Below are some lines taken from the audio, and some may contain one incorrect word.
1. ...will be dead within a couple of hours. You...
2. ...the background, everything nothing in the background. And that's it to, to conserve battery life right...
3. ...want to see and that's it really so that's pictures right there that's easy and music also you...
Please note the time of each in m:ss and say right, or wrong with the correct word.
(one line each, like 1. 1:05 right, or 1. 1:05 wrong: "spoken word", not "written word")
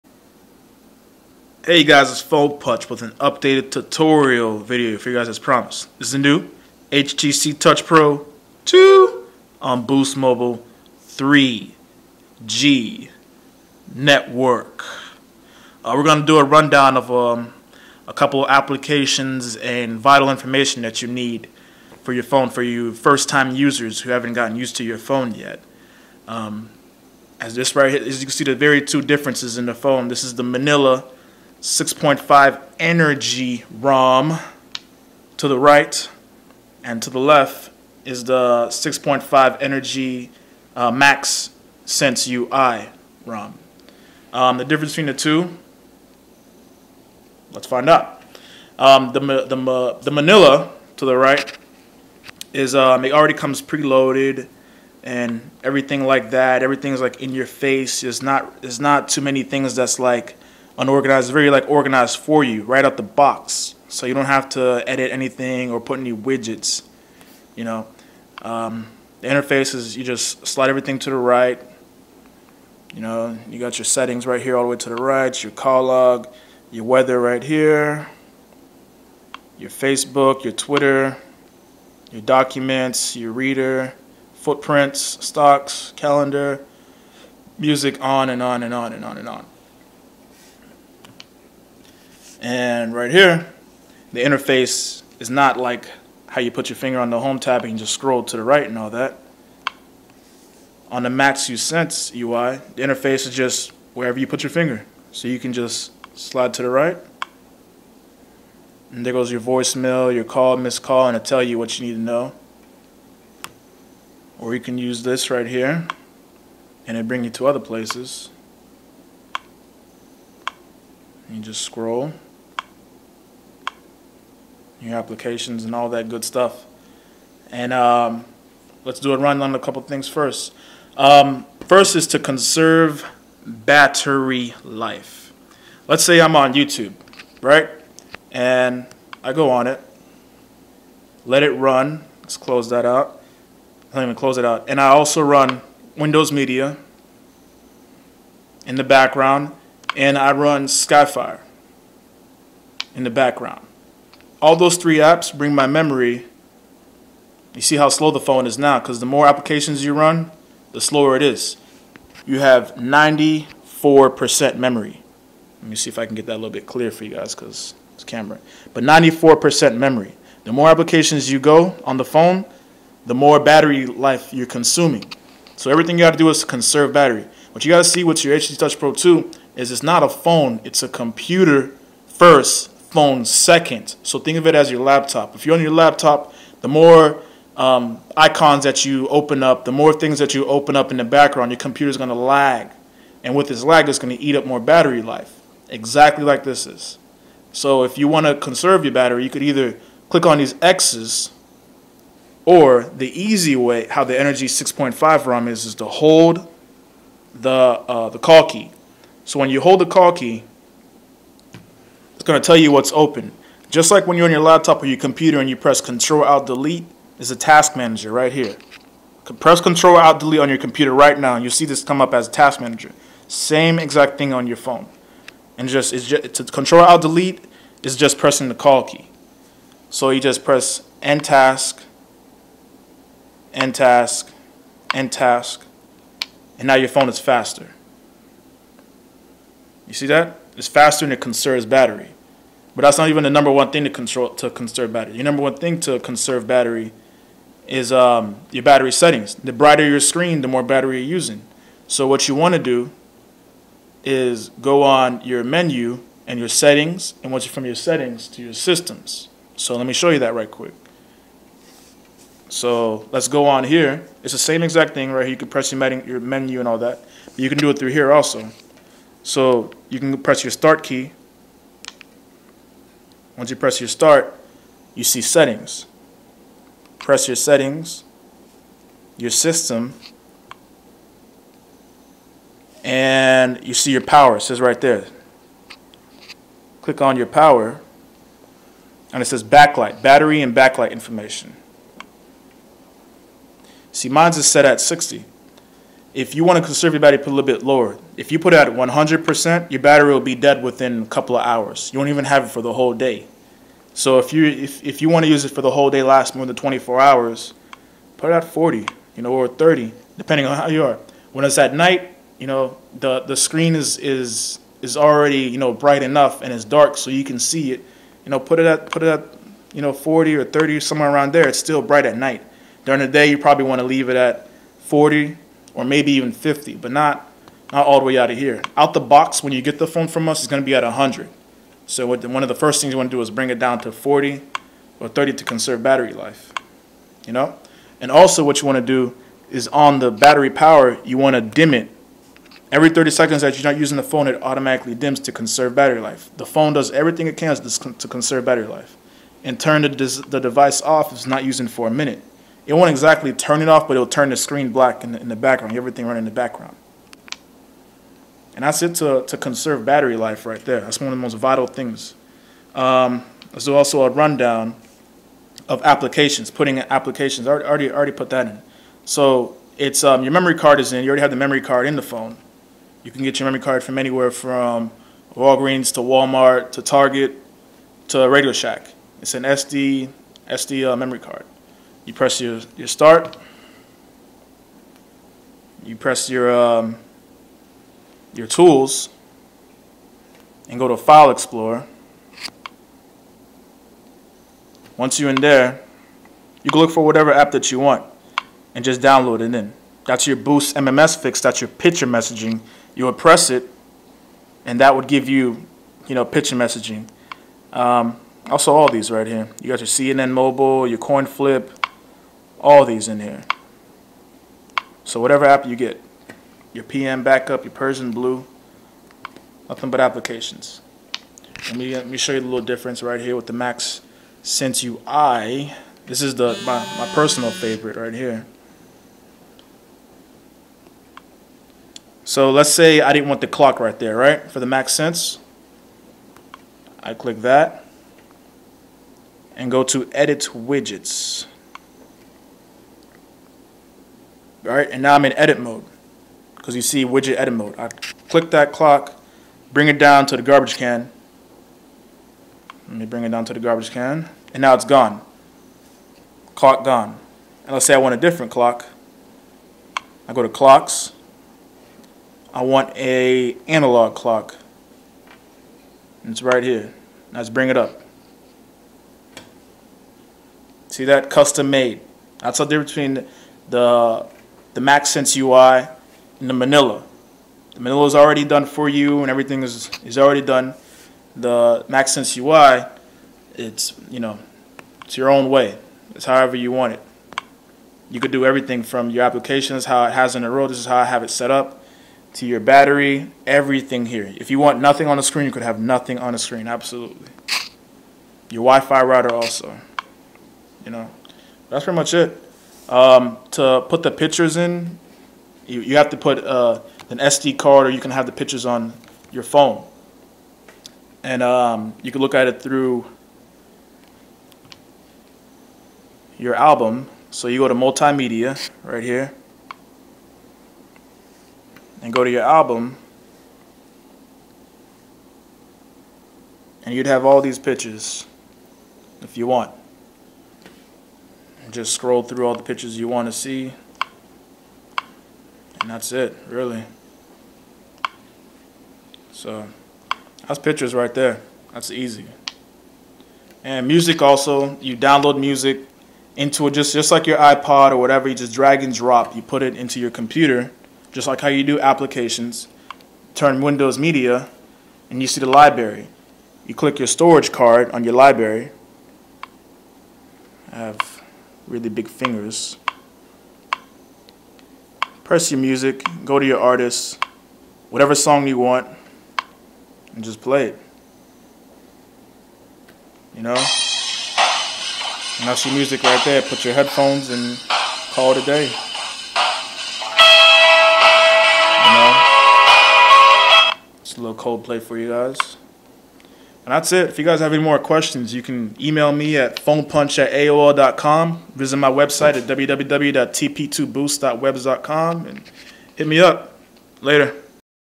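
1. 5:00 right
2. 5:55 wrong: "running", not "nothing"
3. 8:53 right.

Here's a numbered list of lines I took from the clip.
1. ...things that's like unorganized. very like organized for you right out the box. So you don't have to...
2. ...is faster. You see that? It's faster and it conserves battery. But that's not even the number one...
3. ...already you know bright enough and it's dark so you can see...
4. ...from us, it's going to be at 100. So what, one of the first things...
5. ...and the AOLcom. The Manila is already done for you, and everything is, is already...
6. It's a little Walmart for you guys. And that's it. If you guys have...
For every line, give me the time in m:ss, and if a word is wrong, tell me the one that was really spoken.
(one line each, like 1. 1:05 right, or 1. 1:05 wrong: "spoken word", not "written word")
1. 0:59 right
2. 3:57 right
3. 5:14 right
4. 5:30 right
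5. 7:56 wrong: "Manila", not "AOLcom"
6. 9:44 wrong: "Coldplay", not "Walmart".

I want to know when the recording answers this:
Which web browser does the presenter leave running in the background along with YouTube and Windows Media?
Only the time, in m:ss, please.
2:30.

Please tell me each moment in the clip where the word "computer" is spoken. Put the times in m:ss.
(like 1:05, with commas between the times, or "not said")
3:00, 3:11, 3:34, 3:40, 9:10.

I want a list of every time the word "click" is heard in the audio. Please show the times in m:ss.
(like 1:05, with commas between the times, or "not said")
3:20, 4:46, 7:17, 7:28, 9:16.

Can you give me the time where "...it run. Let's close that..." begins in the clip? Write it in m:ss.
2:21.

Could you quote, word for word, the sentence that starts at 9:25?
Press your music, go to your artist, whatever song you want, and just play it.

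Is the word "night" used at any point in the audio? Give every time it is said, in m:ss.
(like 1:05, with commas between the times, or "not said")
5:11, 5:22.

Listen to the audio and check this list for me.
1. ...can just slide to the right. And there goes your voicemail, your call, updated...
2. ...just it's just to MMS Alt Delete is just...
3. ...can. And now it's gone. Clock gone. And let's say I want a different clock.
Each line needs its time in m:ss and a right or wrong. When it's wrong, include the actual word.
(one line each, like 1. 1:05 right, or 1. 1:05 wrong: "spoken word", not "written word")
1. 1:45 wrong: "missed", not "updated"
2. 3:45 wrong: "Control", not "MMS"
3. 7:33 right.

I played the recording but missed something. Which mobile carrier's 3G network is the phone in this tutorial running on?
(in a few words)
Boost Mobile.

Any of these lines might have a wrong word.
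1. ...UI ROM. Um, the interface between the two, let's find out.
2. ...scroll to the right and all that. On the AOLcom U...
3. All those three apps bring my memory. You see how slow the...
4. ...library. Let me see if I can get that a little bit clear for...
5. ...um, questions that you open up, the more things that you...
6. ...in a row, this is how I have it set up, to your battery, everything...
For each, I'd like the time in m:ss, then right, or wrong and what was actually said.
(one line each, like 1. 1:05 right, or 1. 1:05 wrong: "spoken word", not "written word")
1. 0:42 wrong: "difference", not "interface"
2. 1:37 wrong: "Max", not "AOLcom"
3. 2:34 right
4. 2:44 wrong: "memory", not "library"
5. 3:07 wrong: "icons", not "questions"
6. 8:10 right.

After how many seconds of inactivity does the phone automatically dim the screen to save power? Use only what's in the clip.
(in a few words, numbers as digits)
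30 seconds.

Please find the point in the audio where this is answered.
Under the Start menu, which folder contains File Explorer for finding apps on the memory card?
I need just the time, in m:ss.
6:28.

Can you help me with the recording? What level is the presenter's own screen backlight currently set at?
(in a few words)
60.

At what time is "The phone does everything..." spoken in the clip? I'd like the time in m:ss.
5:46.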